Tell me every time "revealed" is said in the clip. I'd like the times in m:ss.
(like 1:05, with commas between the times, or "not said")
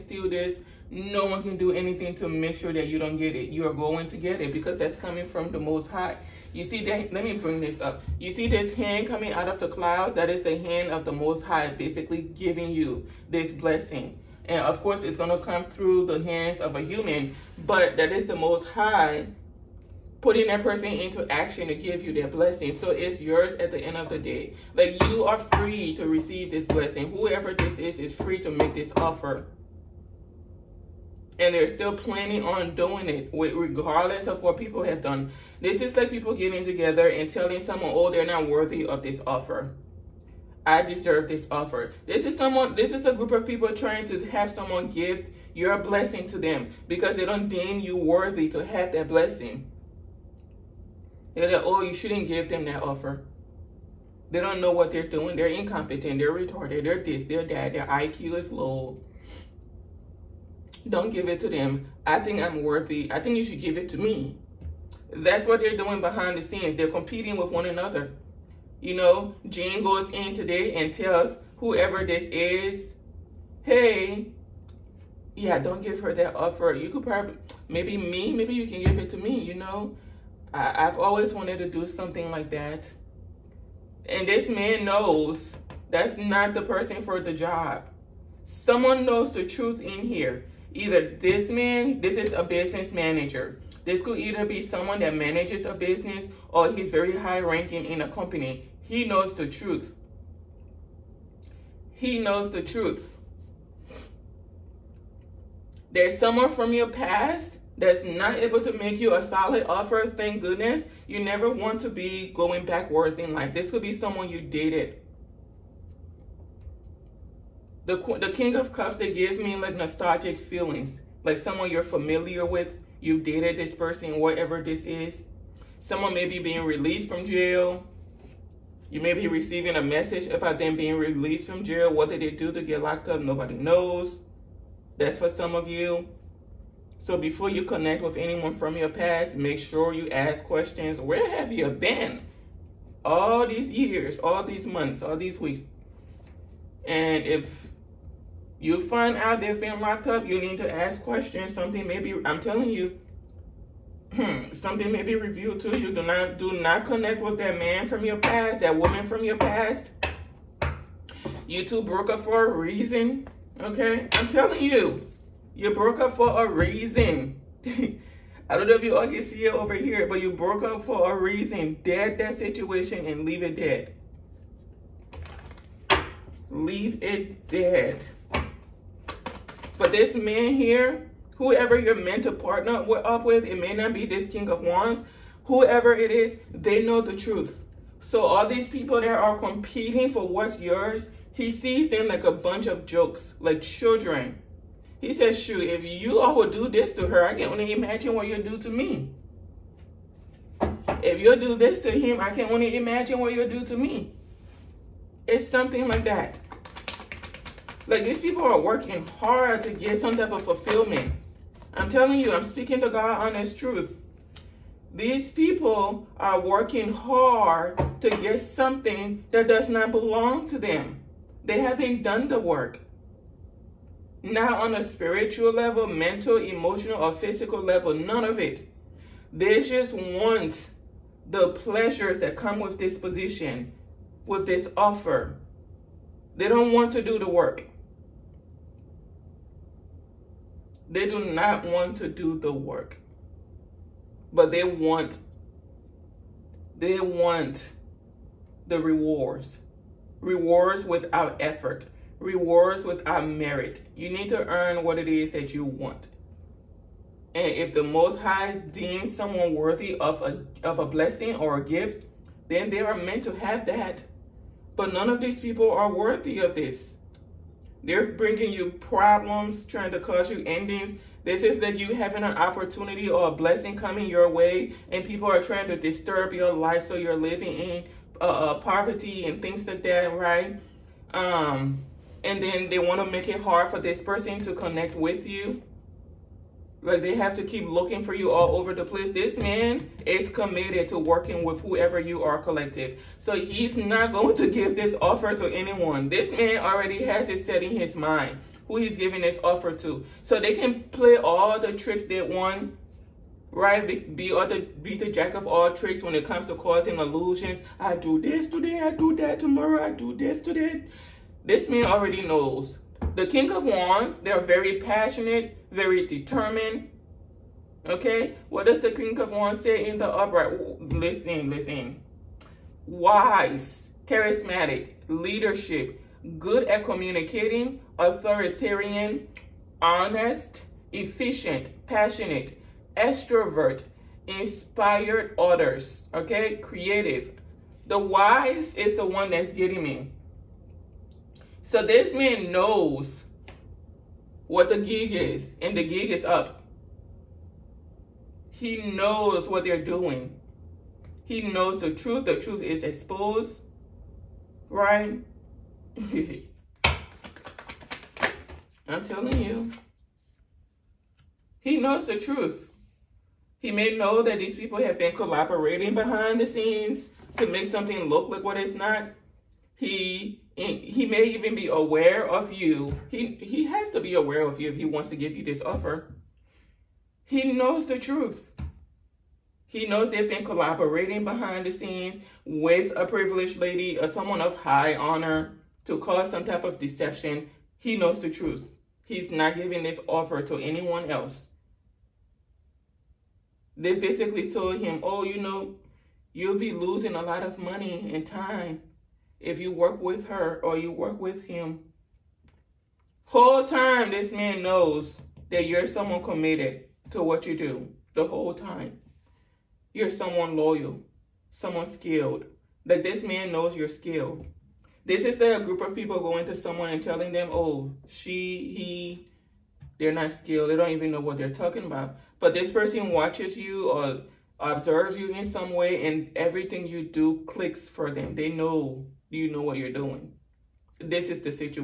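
2:35.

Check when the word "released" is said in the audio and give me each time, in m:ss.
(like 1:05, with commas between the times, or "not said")
2:06, 2:10.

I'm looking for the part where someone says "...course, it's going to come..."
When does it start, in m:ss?
0:14.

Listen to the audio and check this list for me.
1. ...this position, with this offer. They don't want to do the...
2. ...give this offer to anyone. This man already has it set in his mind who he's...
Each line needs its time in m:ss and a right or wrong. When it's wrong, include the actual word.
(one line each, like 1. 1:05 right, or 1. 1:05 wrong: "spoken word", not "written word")
1. 3:52 right
2. 4:54 right.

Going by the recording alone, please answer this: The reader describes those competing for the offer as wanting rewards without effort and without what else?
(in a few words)
Merit.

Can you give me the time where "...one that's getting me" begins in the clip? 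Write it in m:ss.
5:39.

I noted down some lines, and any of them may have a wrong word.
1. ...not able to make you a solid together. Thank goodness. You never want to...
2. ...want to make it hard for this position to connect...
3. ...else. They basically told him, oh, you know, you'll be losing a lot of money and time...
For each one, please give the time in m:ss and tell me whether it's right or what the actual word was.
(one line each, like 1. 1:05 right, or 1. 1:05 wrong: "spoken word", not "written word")
1. 1:48 wrong: "offer", not "together"
2. 4:42 wrong: "person", not "position"
3. 6:31 right.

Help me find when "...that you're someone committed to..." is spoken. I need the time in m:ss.
6:45.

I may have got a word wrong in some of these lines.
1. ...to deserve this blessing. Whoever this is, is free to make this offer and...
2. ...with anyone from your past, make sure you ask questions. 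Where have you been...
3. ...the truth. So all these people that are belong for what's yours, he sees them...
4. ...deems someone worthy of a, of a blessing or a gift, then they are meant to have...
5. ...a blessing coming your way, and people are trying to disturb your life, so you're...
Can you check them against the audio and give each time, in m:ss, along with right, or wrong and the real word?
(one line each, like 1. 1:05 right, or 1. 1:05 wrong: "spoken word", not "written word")
1. 0:25 wrong: "receive", not "deserve"
2. 2:18 right
3. 3:07 wrong: "competing", not "belong"
4. 4:18 right
5. 4:33 right.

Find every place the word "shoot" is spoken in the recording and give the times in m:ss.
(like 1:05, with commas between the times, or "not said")
3:15.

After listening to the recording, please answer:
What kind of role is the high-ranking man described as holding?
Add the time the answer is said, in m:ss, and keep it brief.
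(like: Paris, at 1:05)
Business manager, at 1:32.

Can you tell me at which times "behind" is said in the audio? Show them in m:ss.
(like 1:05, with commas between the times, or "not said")
1:06, 6:05, 6:21.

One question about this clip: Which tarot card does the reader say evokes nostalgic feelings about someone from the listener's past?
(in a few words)
King of Cups.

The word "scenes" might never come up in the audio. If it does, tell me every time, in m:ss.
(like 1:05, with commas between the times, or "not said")
1:06, 6:06, 6:21.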